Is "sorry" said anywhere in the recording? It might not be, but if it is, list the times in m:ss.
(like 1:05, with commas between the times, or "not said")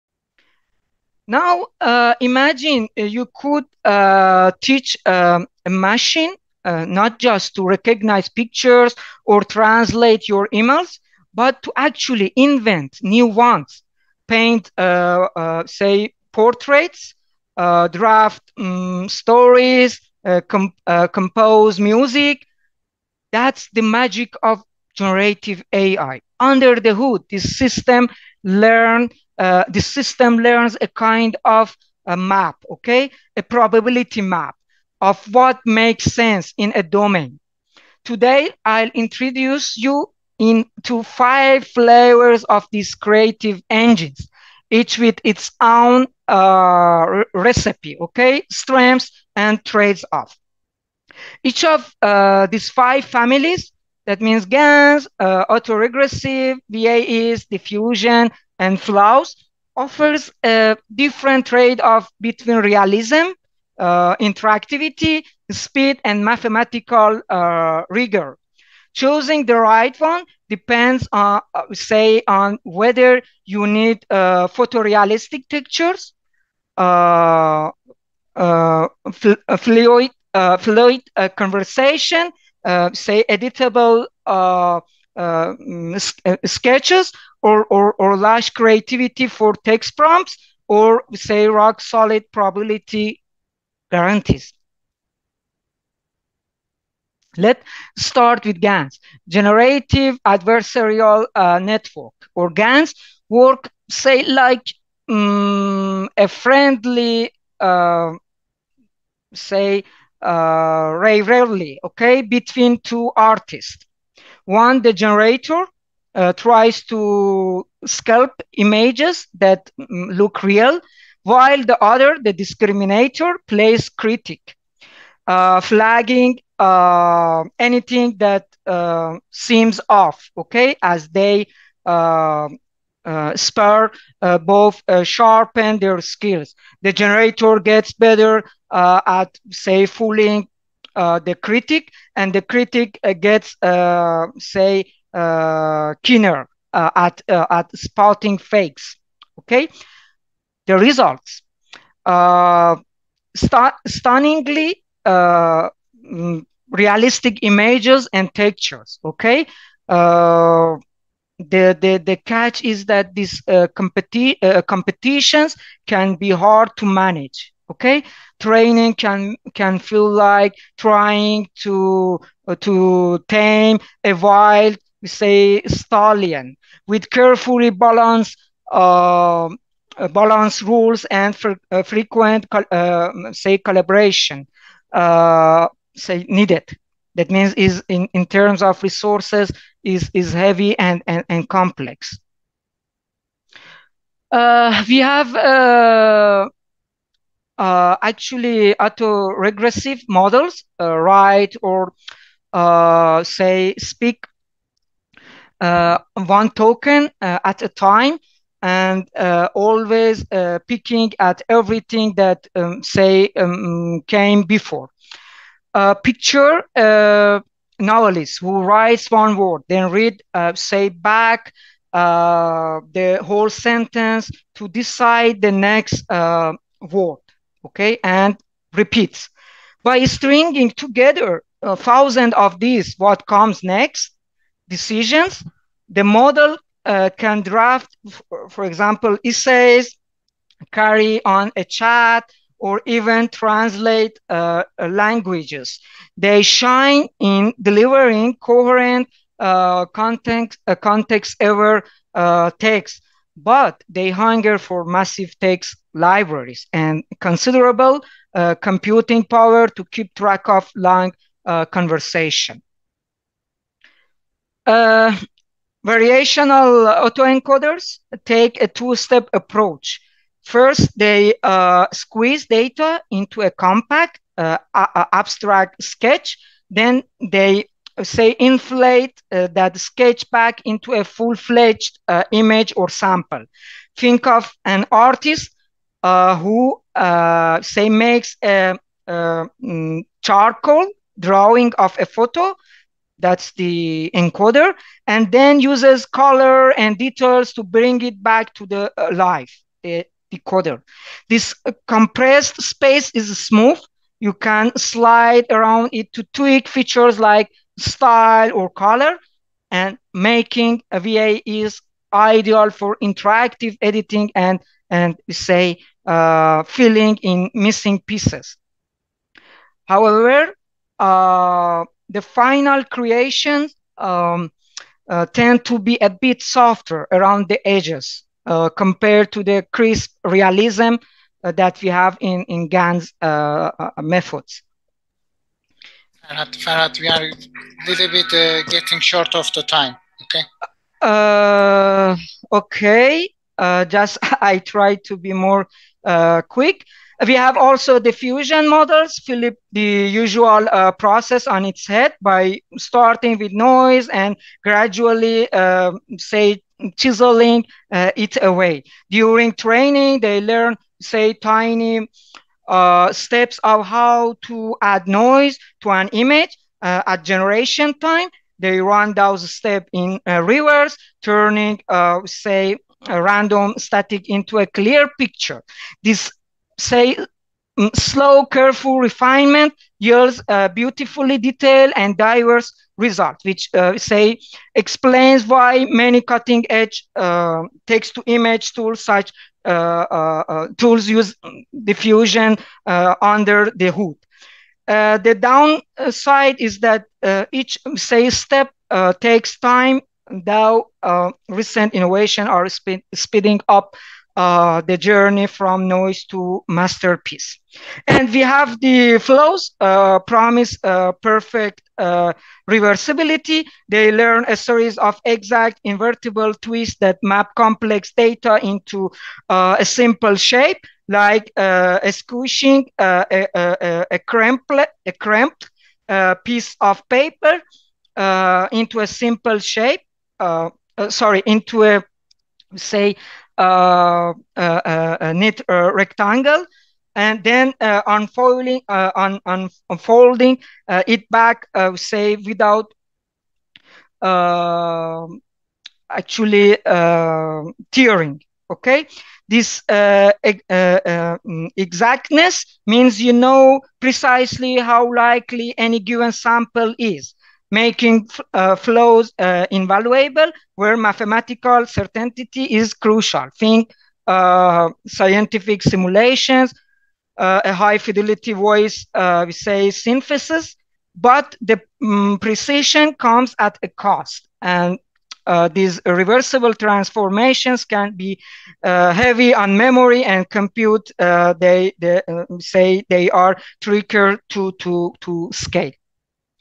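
7:11.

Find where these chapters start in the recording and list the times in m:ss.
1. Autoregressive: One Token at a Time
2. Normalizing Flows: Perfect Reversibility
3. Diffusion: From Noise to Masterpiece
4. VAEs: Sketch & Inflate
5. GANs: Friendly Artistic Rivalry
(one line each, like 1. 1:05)
1. 3:14
2. 6:48
3. 5:47
4. 4:25
5. 1:37.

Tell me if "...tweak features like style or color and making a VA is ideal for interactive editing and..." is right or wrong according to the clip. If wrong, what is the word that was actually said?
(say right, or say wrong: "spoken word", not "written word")
right.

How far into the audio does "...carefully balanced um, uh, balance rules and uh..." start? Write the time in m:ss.
2:57.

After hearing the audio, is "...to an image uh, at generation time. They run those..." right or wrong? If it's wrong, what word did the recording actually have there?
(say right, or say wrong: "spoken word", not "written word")
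right.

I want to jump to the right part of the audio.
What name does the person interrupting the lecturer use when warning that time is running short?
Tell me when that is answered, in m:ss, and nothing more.
5:36.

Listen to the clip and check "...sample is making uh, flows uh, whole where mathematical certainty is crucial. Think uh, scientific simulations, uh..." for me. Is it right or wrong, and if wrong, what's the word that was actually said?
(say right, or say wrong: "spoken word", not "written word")
wrong: "invaluable", not "whole".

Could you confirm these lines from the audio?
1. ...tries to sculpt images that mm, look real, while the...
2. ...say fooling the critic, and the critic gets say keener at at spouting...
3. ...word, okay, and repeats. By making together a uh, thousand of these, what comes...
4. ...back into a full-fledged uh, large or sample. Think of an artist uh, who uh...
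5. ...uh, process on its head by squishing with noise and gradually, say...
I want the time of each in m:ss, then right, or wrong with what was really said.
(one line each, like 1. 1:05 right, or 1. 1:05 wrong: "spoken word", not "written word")
1. 1:56 right
2. 2:19 right
3. 3:46 wrong: "stringing", not "making"
4. 4:40 wrong: "image", not "large"
5. 5:50 wrong: "starting", not "squishing".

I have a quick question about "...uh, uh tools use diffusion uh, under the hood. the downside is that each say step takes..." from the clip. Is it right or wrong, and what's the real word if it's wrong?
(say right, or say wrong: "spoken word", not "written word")
right.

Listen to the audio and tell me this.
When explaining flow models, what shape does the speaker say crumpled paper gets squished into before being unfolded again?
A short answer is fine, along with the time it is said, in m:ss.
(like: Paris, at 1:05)
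rectangle, at 7:15.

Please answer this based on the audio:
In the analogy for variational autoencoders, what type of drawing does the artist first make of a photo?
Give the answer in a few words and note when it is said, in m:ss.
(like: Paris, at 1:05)
charcoal drawing, at 4:50.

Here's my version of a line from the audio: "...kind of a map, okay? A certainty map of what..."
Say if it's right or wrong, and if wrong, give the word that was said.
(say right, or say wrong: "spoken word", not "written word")
wrong: "probability", not "certainty".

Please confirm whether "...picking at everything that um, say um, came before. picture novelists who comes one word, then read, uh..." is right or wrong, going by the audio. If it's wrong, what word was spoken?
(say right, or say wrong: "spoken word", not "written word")
wrong: "writes", not "comes".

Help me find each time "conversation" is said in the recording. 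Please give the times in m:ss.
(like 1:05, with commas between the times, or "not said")
1:21, 4:21.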